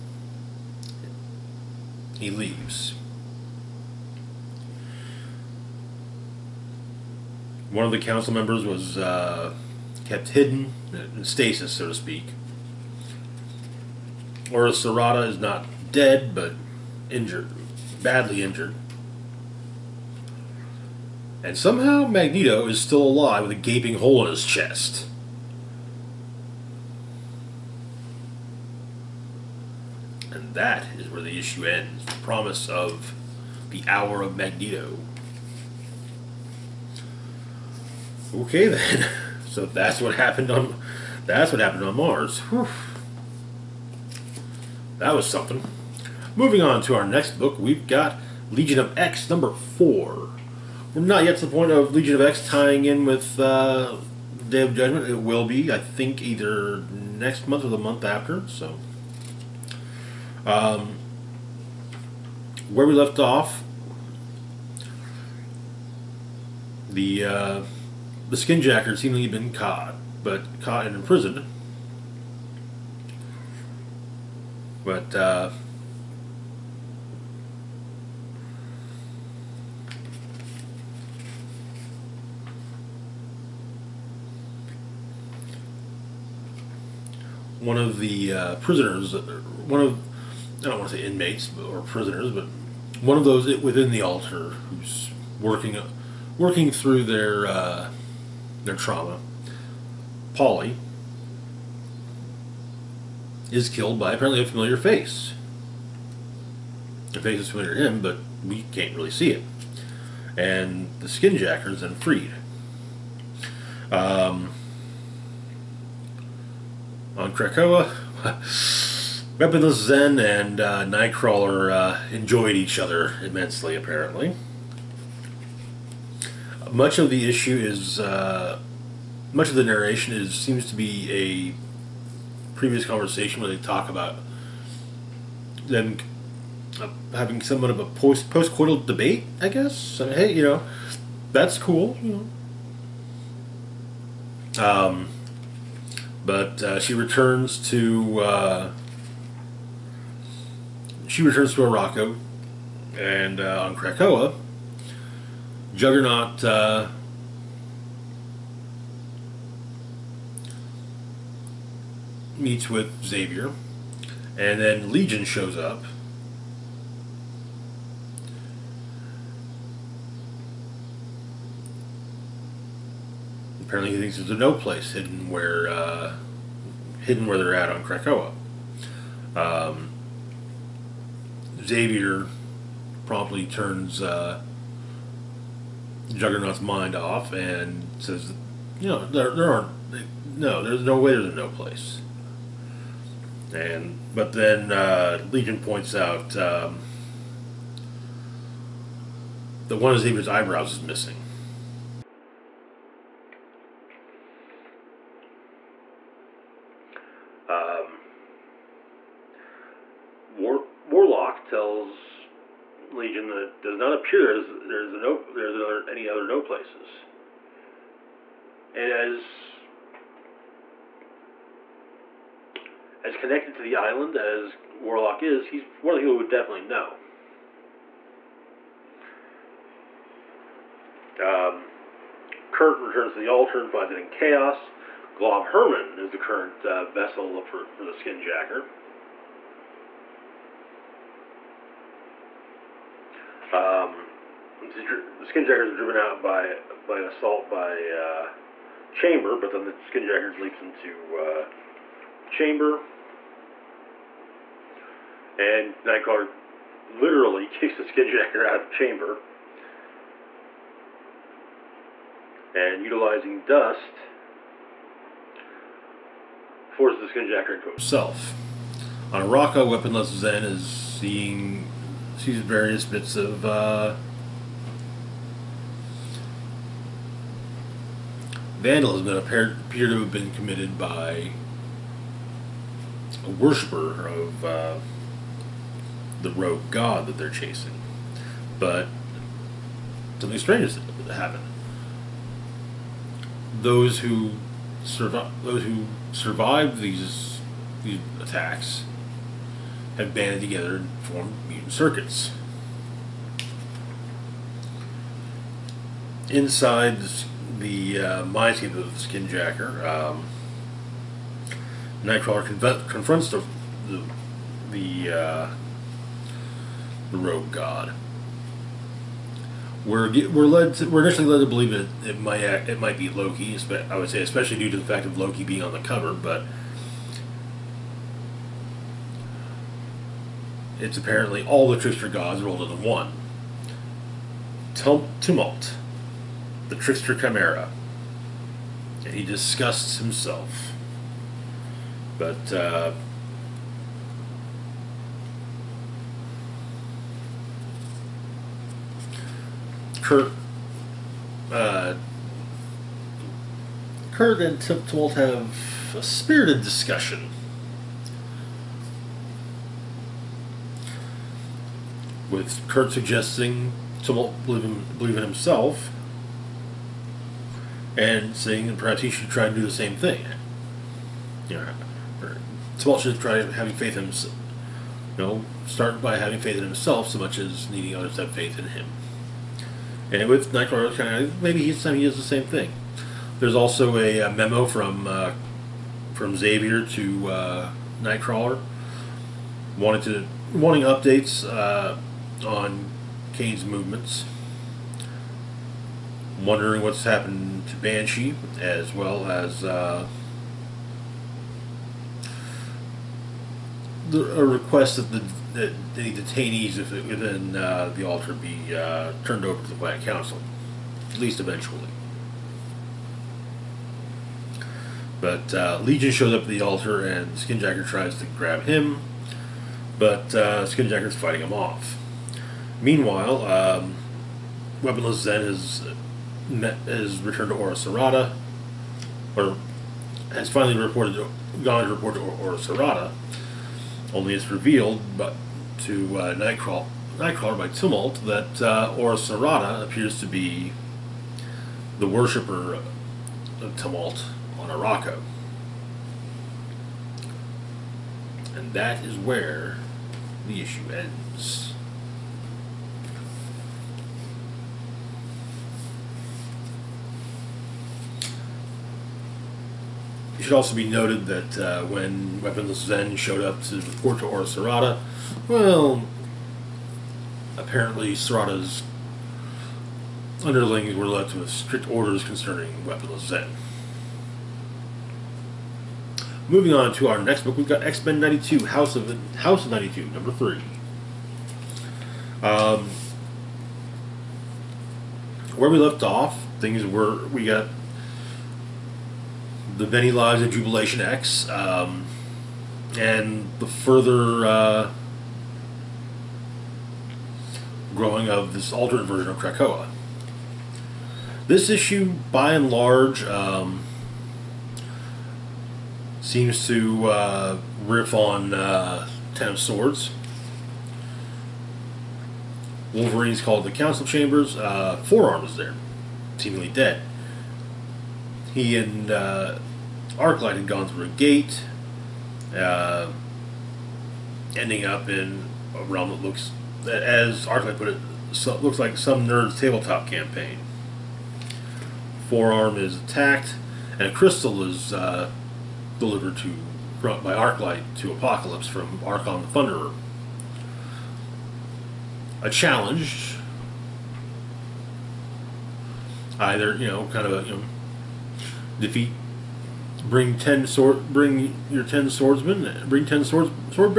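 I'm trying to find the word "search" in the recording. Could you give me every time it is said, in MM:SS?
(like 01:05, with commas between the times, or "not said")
not said.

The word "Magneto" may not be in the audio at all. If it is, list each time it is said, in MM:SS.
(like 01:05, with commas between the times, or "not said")
00:22, 00:34.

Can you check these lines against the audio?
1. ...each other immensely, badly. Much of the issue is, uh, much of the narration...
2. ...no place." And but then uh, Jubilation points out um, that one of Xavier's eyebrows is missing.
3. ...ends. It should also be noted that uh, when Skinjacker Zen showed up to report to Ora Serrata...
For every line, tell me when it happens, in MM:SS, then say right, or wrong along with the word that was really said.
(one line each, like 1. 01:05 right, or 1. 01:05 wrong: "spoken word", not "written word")
1. 02:02 wrong: "apparently", not "badly"
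2. 03:11 wrong: "Legion", not "Jubilation"
3. 07:30 wrong: "Weaponless", not "Skinjacker".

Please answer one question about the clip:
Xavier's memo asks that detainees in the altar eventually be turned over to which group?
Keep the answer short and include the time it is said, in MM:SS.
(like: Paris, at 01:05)
Black Council, at 06:49.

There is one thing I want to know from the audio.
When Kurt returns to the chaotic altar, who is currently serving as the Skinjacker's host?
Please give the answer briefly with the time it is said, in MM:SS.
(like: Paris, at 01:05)
Glob Herman, at 03:55.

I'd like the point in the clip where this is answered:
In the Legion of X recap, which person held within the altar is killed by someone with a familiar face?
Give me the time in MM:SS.
01:40.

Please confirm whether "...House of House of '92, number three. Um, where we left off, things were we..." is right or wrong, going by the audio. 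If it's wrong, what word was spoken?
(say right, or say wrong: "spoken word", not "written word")
right.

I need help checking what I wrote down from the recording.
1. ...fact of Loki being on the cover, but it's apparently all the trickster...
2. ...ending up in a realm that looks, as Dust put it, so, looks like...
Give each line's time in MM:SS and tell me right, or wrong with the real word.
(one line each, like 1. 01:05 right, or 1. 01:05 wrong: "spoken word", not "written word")
1. 05:24 right
2. 08:44 wrong: "Arclight", not "Dust".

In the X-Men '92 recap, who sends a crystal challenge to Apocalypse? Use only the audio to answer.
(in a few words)
Archon the Thunderer.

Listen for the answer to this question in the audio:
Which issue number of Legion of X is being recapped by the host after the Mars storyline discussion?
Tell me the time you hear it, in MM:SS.
00:49.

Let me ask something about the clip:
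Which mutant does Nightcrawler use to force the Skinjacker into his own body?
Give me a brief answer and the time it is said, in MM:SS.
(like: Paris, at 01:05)
Dust, at 04:23.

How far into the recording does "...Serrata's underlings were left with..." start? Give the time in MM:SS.
07:48.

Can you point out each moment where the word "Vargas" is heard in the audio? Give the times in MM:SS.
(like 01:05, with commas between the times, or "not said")
not said.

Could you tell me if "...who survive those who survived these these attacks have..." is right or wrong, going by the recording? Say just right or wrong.
right.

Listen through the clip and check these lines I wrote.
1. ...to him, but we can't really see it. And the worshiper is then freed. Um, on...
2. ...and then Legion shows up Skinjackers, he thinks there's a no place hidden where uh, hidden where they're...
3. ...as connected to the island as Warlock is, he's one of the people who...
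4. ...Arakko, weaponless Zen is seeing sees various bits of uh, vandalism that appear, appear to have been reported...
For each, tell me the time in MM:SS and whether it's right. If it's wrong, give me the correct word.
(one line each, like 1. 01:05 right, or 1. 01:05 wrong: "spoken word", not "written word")
1. 01:47 wrong: "skinjacker", not "worshiper"
2. 02:44 wrong: "Apparently", not "Skinjackers"
3. 03:43 right
4. 04:29 wrong: "committed", not "reported".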